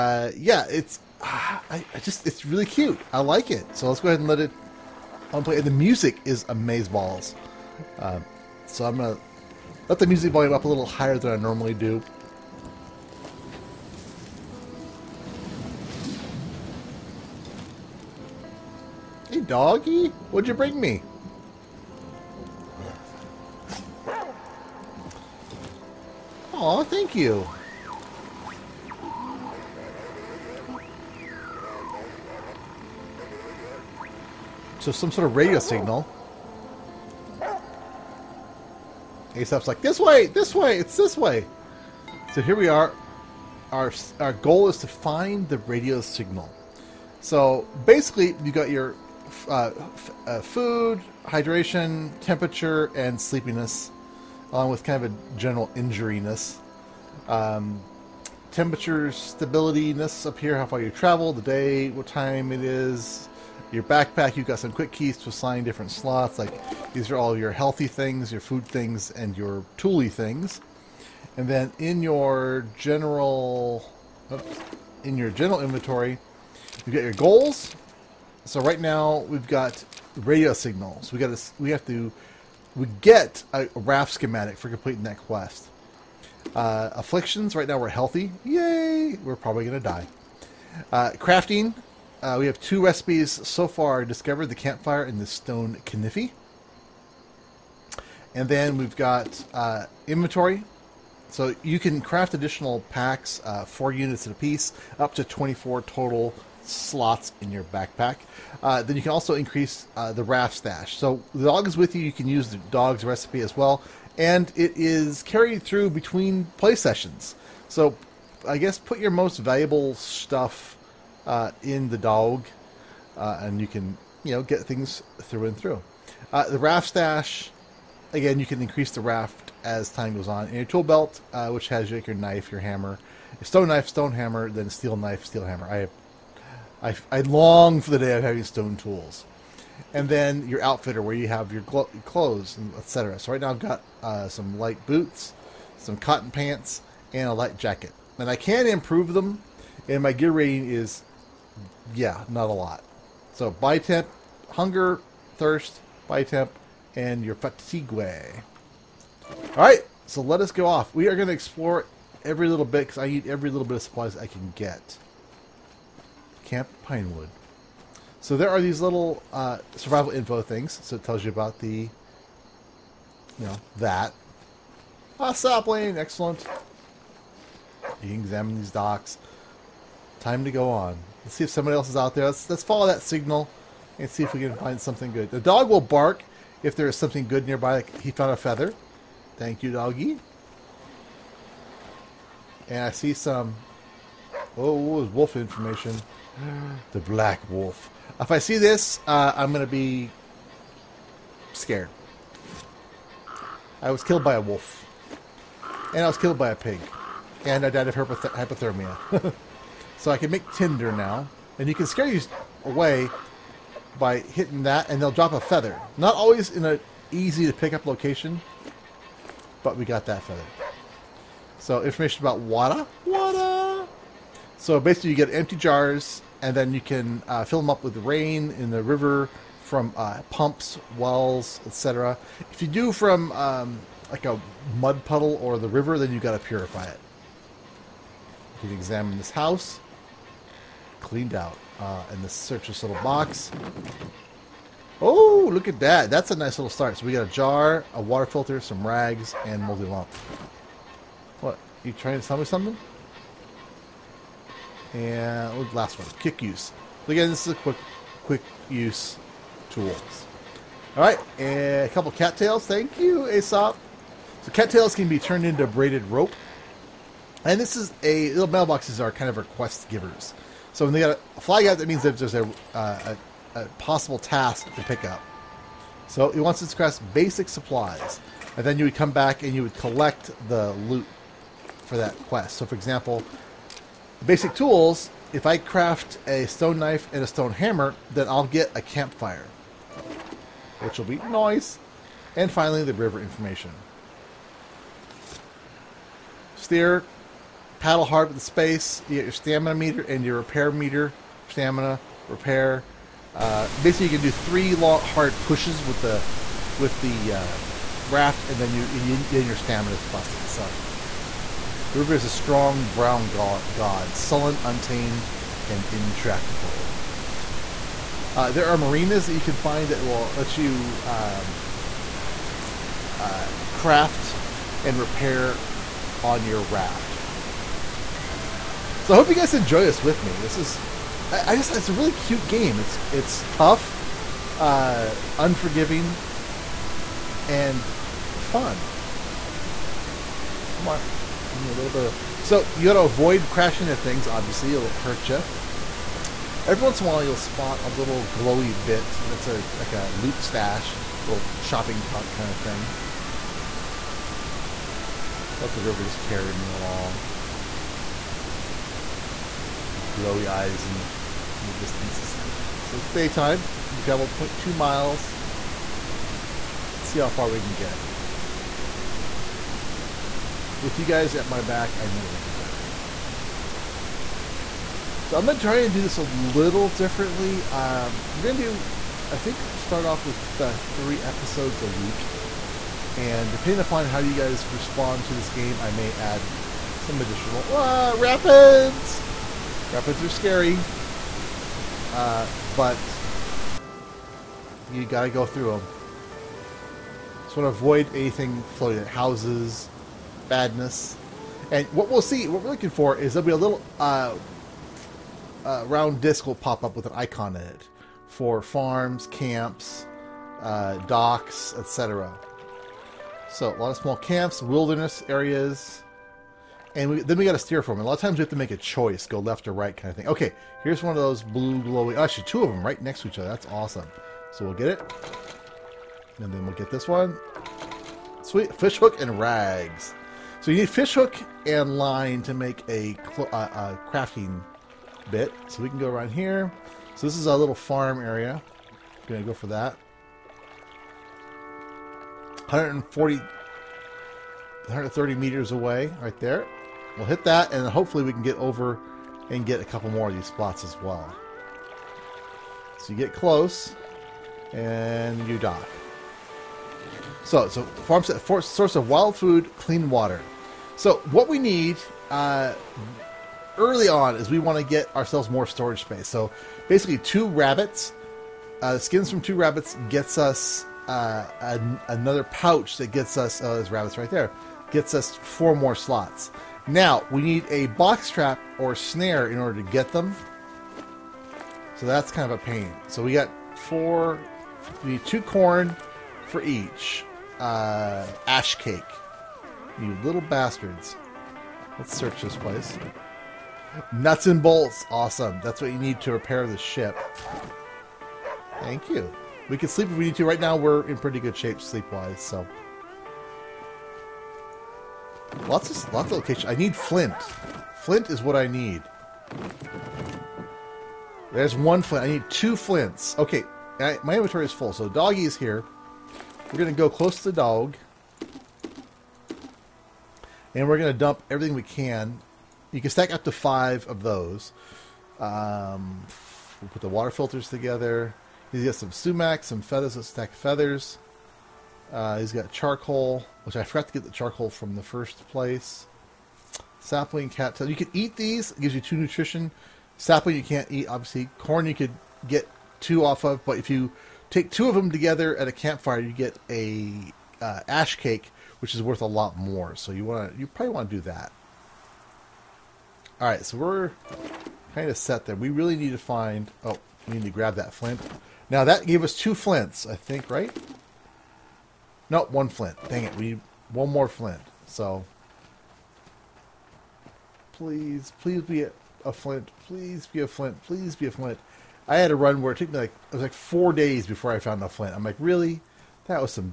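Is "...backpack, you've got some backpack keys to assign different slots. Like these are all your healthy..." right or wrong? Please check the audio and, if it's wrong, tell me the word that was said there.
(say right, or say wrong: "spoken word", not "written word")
wrong: "quick", not "backpack".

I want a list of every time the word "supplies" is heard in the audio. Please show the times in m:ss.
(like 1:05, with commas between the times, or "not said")
2:43, 4:37.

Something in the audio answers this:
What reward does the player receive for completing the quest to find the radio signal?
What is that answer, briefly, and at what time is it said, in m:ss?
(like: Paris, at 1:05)
Raft schematic, at 1:23.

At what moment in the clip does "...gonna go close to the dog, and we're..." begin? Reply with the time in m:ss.
8:36.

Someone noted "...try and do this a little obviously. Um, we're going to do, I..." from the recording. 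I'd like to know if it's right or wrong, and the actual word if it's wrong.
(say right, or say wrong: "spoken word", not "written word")
wrong: "differently", not "obviously".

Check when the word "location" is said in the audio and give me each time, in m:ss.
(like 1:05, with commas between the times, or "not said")
3:37, 8:26.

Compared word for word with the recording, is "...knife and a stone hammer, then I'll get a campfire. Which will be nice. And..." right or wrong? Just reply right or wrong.
right.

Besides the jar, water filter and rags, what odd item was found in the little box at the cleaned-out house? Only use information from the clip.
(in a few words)
Moldy lump.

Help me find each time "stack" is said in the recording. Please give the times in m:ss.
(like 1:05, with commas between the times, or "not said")
8:43, 8:50.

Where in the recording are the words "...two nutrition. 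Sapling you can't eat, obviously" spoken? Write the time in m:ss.
8:59.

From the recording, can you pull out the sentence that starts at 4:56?
Steer, paddle hard with the space.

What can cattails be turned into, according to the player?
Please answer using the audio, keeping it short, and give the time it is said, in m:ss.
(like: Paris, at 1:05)
Braided rope, at 4:25.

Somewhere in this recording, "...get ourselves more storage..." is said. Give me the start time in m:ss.
7:44.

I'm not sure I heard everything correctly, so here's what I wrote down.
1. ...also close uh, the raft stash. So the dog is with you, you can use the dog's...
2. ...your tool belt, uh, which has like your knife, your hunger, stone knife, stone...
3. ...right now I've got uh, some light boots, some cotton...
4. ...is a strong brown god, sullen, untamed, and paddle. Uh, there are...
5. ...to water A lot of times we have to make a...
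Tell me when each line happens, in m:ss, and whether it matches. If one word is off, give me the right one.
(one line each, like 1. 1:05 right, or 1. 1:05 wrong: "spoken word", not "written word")
1. 1:49 wrong: "increase", not "close"
2. 2:10 wrong: "hammer", not "hunger"
3. 2:23 right
4. 5:12 wrong: "intractable", not "paddle"
5. 6:57 wrong: "steer", not "water".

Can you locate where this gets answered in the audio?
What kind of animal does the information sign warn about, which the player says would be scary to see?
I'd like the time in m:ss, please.
3:16.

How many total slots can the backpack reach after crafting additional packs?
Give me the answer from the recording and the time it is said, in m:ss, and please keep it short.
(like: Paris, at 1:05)
24, at 1:45.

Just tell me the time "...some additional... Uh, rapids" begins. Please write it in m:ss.
6:26.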